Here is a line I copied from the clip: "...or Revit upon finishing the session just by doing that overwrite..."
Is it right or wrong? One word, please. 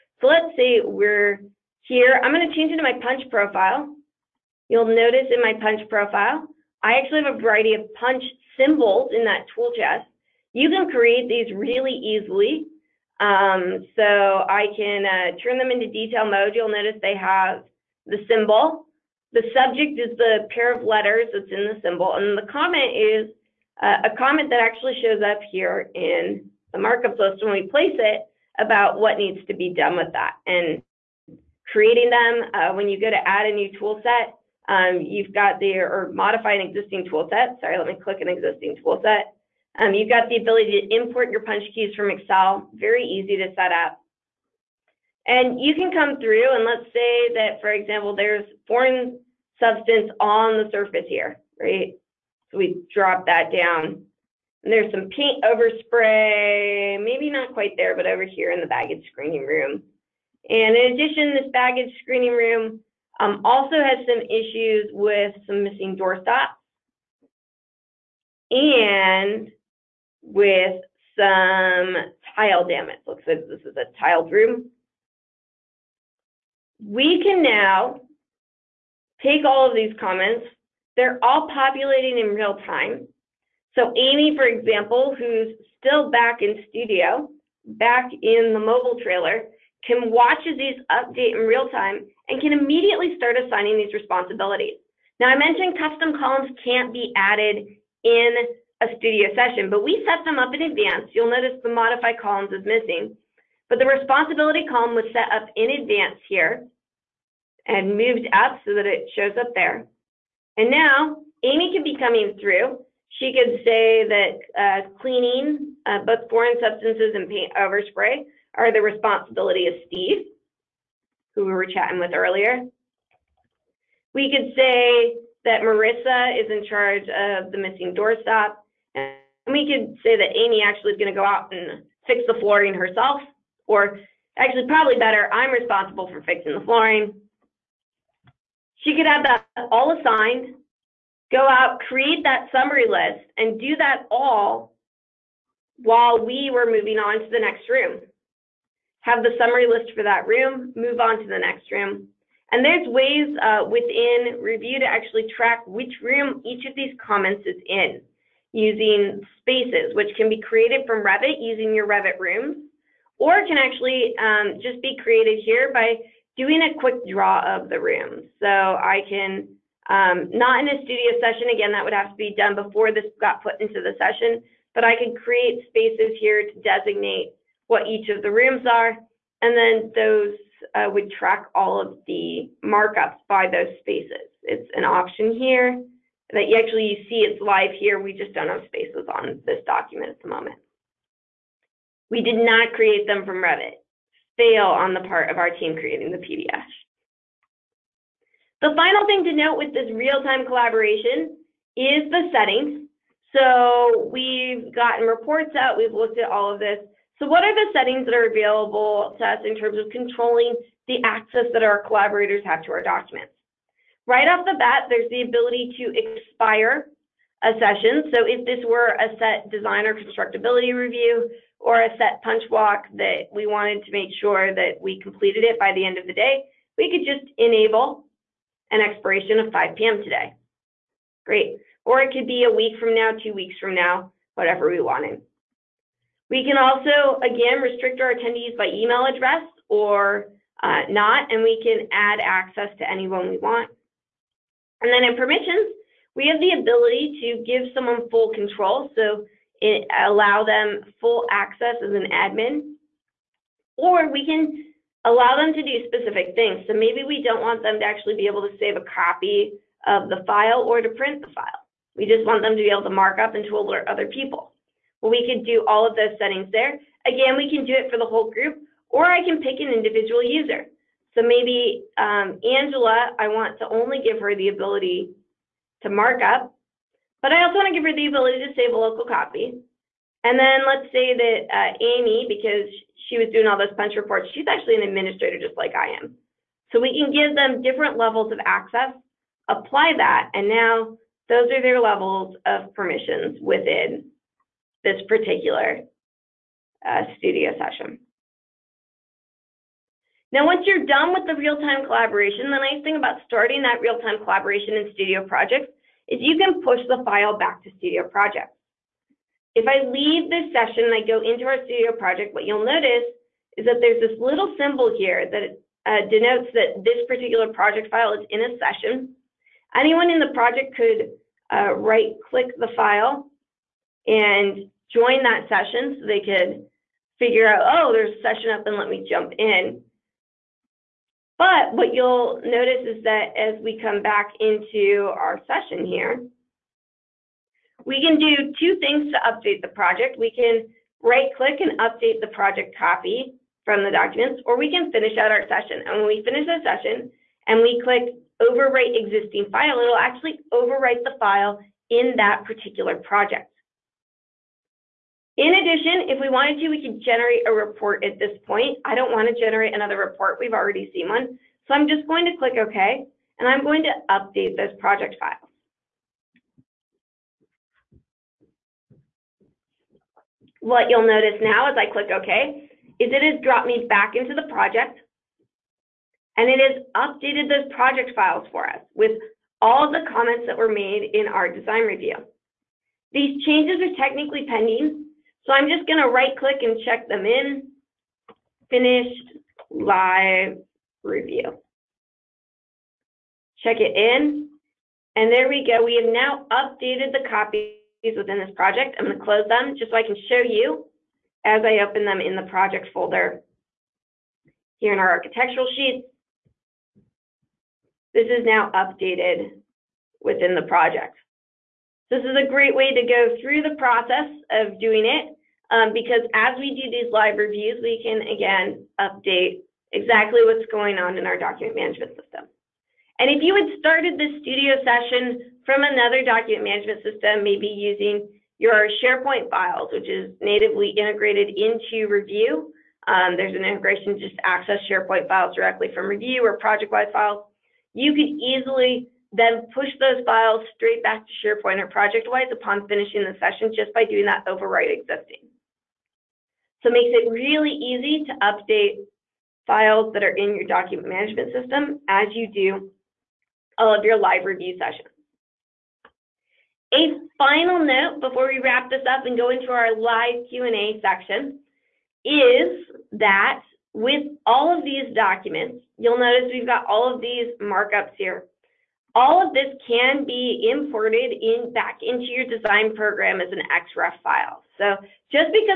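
wrong.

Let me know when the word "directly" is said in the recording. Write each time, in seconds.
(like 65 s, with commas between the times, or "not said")
435 s.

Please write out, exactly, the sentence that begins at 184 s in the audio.
It's an option here that you actually you see it's live here.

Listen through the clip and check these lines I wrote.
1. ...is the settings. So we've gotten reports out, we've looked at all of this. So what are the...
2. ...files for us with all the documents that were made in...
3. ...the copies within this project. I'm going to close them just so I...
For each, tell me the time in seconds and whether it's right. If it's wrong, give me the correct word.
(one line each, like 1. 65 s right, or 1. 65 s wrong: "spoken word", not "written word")
1. 201 s right
2. 378 s wrong: "comments", not "documents"
3. 397 s right.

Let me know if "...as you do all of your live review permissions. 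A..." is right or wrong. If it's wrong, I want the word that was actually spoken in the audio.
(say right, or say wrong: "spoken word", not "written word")
wrong: "sessions", not "permissions".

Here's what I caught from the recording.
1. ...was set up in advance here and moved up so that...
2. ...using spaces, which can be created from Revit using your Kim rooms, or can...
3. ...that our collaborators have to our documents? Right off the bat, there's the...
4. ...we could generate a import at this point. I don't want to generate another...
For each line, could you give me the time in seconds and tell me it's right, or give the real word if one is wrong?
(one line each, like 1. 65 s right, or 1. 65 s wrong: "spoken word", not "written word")
1. 104 s right
2. 158 s wrong: "Revit", not "Kim"
3. 211 s right
4. 356 s wrong: "report", not "import".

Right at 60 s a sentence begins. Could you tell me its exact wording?
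And in addition, this baggage screening room um, also has some issues with some missing door stops and with some tile damage.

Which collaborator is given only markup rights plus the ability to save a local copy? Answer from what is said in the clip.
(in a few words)
Angela.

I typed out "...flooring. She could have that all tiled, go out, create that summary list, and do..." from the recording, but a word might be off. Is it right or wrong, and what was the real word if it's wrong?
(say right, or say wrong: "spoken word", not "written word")
wrong: "assigned", not "tiled".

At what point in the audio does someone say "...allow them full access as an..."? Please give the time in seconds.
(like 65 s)
250 s.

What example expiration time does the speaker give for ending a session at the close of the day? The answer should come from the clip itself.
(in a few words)
5 p.m.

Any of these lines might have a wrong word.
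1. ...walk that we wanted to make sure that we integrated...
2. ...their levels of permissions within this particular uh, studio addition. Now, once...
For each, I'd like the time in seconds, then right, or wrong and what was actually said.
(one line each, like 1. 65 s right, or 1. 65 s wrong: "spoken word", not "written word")
1. 222 s wrong: "completed", not "integrated"
2. 291 s wrong: "session", not "addition".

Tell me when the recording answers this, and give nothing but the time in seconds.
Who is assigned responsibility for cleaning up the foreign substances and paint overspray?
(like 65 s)
119 s.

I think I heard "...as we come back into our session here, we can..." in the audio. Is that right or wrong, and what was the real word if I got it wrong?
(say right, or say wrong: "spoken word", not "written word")
right.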